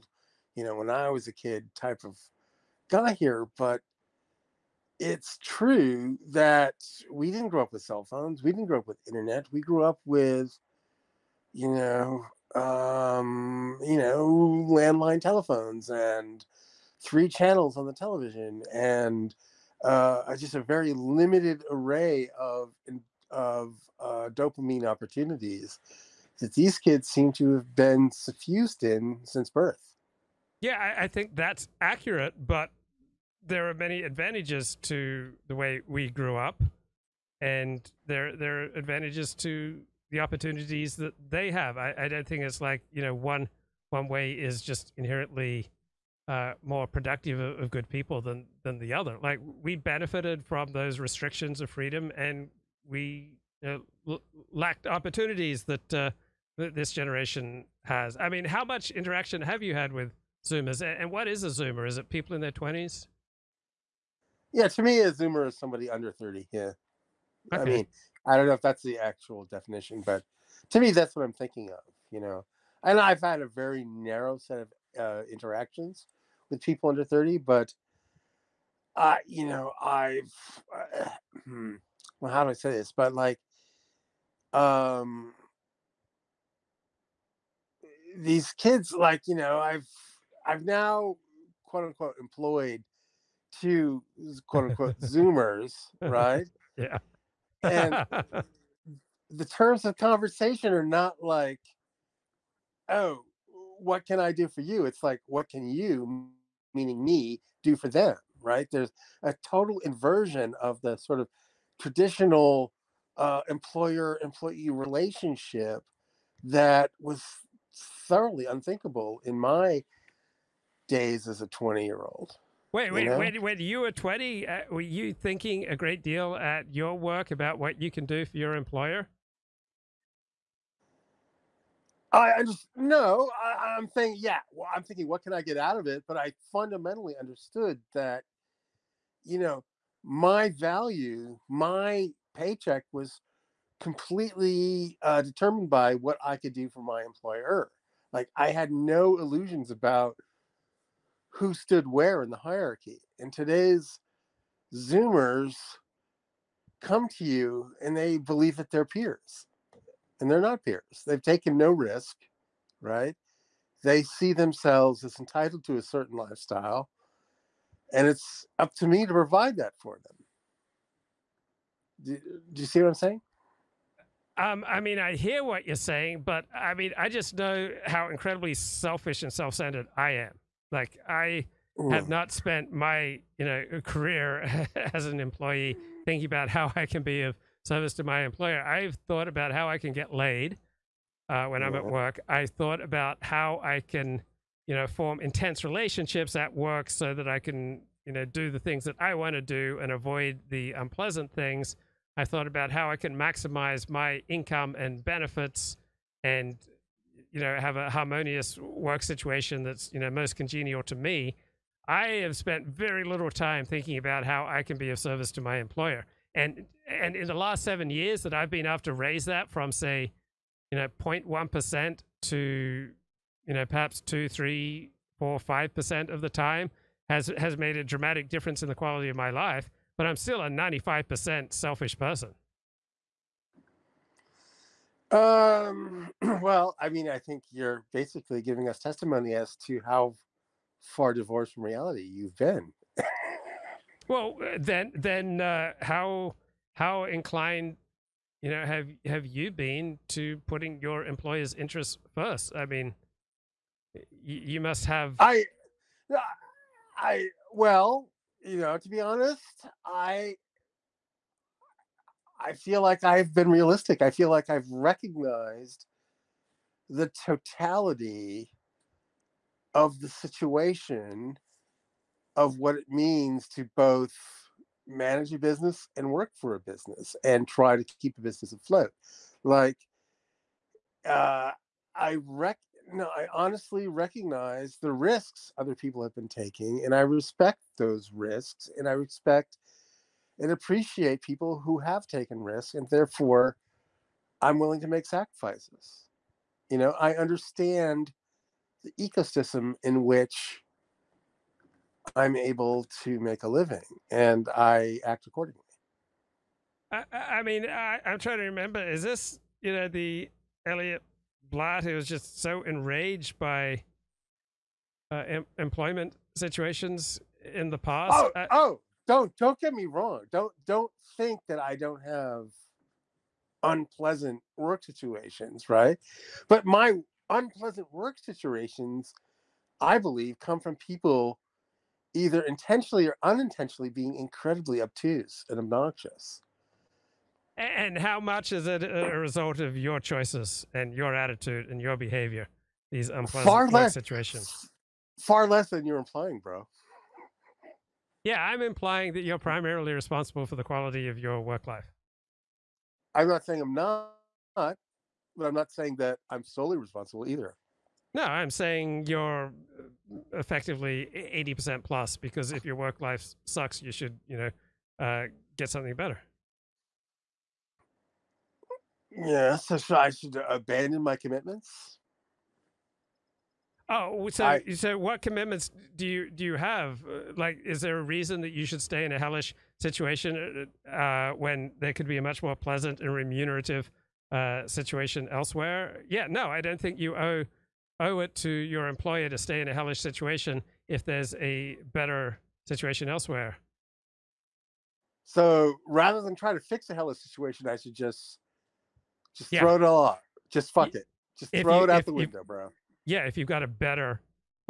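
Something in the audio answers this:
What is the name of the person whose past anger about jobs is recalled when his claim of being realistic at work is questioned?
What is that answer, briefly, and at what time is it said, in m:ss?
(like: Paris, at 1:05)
Elliott Blatt, at 5:10.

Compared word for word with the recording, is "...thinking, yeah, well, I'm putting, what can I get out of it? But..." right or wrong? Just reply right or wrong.
wrong.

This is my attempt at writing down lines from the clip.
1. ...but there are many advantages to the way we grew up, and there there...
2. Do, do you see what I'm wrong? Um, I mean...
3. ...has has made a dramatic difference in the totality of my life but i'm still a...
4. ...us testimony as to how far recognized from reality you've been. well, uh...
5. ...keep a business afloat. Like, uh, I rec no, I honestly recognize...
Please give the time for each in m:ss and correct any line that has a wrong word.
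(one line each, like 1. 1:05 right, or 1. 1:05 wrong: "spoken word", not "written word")
1. 0:32 right
2. 2:52 wrong: "saying", not "wrong"
3. 3:47 wrong: "quality", not "totality"
4. 3:58 wrong: "divorced", not "recognized"
5. 4:38 right.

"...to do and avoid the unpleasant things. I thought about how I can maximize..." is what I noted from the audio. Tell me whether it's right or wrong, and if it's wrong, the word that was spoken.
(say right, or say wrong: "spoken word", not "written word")
right.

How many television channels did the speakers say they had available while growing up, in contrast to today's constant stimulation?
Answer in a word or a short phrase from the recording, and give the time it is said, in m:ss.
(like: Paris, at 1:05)
3, at 0:17.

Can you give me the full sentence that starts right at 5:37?
And how much is it a result of your choices and your attitude and your behavior?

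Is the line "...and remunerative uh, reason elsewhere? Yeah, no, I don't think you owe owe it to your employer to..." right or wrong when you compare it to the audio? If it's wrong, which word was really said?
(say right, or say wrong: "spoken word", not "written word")
wrong: "situation", not "reason".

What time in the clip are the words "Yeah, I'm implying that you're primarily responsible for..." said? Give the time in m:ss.
5:48.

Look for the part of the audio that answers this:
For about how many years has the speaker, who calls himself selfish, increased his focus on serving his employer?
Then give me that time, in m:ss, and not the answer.
3:37.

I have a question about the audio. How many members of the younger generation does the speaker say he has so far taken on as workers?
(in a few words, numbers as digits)
2.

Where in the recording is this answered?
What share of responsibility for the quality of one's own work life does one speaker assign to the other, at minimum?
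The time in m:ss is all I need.
6:01.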